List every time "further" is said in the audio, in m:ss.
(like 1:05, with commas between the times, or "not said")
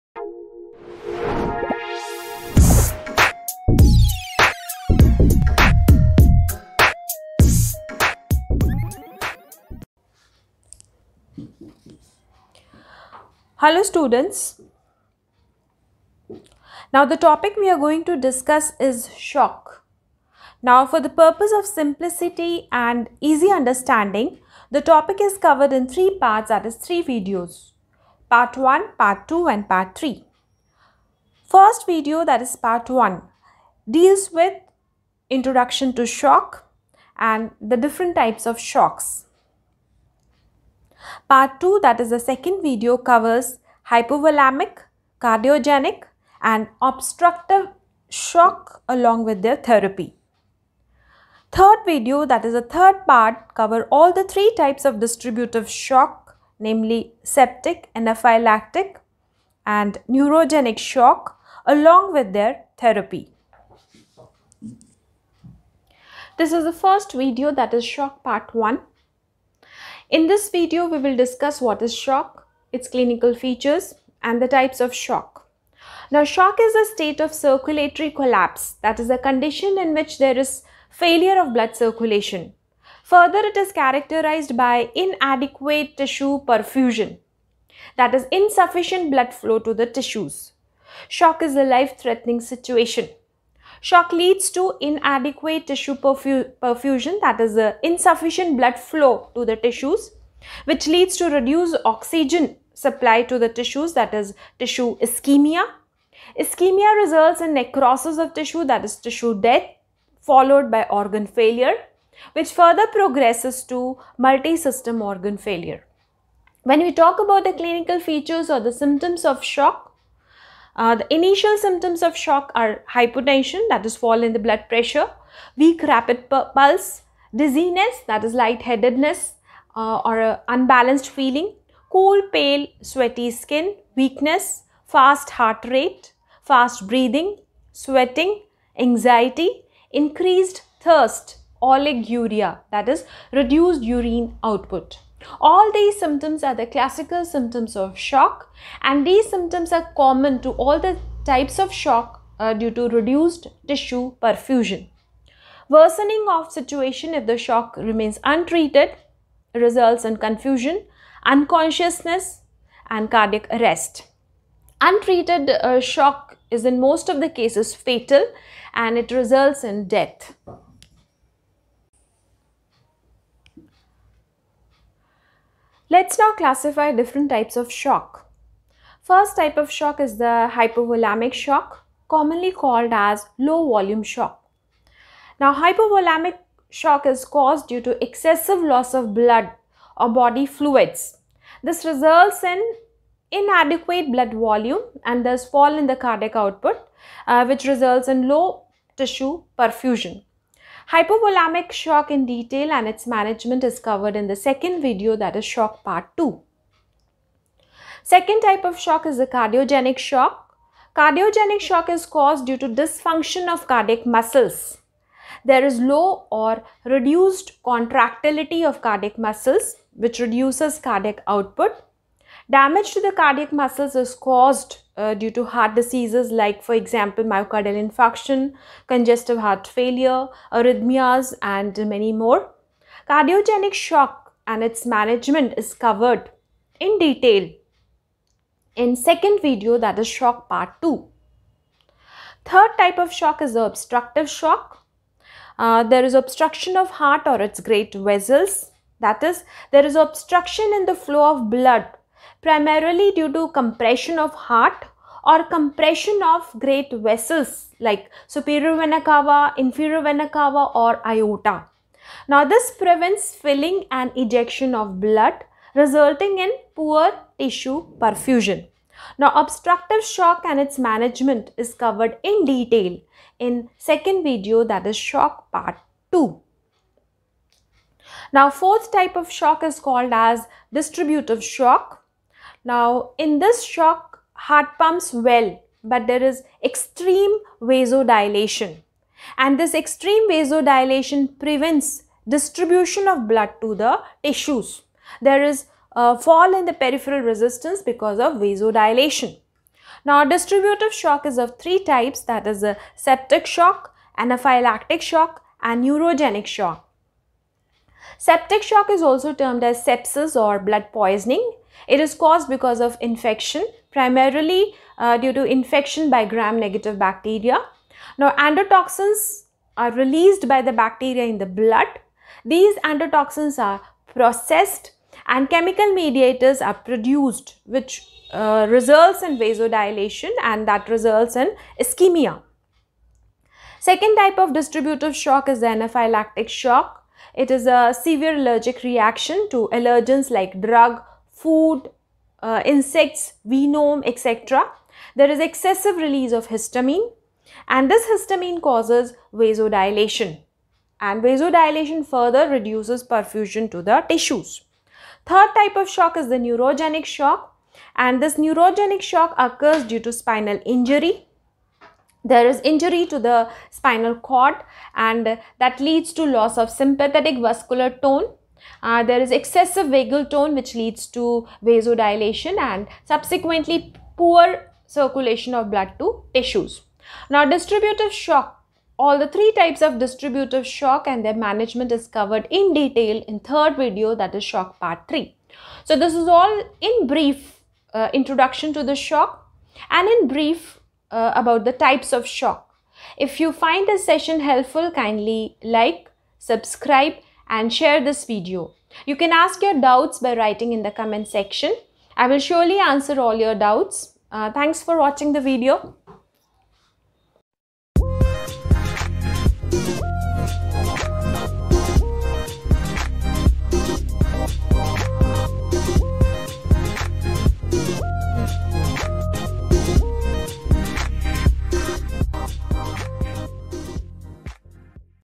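1:23, 1:52, 5:52.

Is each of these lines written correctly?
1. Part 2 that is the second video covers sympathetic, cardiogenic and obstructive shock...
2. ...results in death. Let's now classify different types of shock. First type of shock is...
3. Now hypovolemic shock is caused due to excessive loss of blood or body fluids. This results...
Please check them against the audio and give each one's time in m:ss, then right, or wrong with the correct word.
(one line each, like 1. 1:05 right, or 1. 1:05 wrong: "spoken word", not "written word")
1. 0:41 wrong: "hypovolemic", not "sympathetic"
2. 2:49 right
3. 3:05 right.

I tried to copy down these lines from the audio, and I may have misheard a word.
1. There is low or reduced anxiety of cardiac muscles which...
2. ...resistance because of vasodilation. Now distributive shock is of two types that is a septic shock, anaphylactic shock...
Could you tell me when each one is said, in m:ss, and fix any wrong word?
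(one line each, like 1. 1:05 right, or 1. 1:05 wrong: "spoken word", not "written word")
1. 3:35 wrong: "contractility", not "anxiety"
2. 4:57 wrong: "three", not "two".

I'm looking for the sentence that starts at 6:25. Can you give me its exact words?
So this is all in brief uh, introduction to the shock and in brief uh, about the types of shock.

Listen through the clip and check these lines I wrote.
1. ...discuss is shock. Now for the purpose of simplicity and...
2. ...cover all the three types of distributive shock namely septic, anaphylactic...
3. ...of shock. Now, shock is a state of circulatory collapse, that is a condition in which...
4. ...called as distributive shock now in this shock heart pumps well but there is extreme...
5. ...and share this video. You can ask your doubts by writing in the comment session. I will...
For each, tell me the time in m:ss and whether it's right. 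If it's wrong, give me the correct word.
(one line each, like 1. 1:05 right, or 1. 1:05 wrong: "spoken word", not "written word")
1. 0:18 right
2. 0:53 right
3. 1:14 right
4. 4:39 right
5. 6:37 wrong: "section", not "session".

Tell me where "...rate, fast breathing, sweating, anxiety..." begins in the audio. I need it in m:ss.
2:15.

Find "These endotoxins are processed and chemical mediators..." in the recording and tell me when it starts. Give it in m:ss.
5:22.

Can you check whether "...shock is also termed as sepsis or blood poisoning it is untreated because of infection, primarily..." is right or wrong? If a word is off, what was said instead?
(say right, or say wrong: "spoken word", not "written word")
wrong: "caused", not "untreated".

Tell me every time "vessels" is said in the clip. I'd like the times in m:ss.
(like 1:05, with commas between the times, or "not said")
4:07, 4:17.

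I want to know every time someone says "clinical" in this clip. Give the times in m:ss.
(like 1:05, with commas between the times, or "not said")
1:12, 1:57.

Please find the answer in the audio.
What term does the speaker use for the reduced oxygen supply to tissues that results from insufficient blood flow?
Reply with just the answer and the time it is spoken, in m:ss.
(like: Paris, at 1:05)
tissue ischemia, at 1:44.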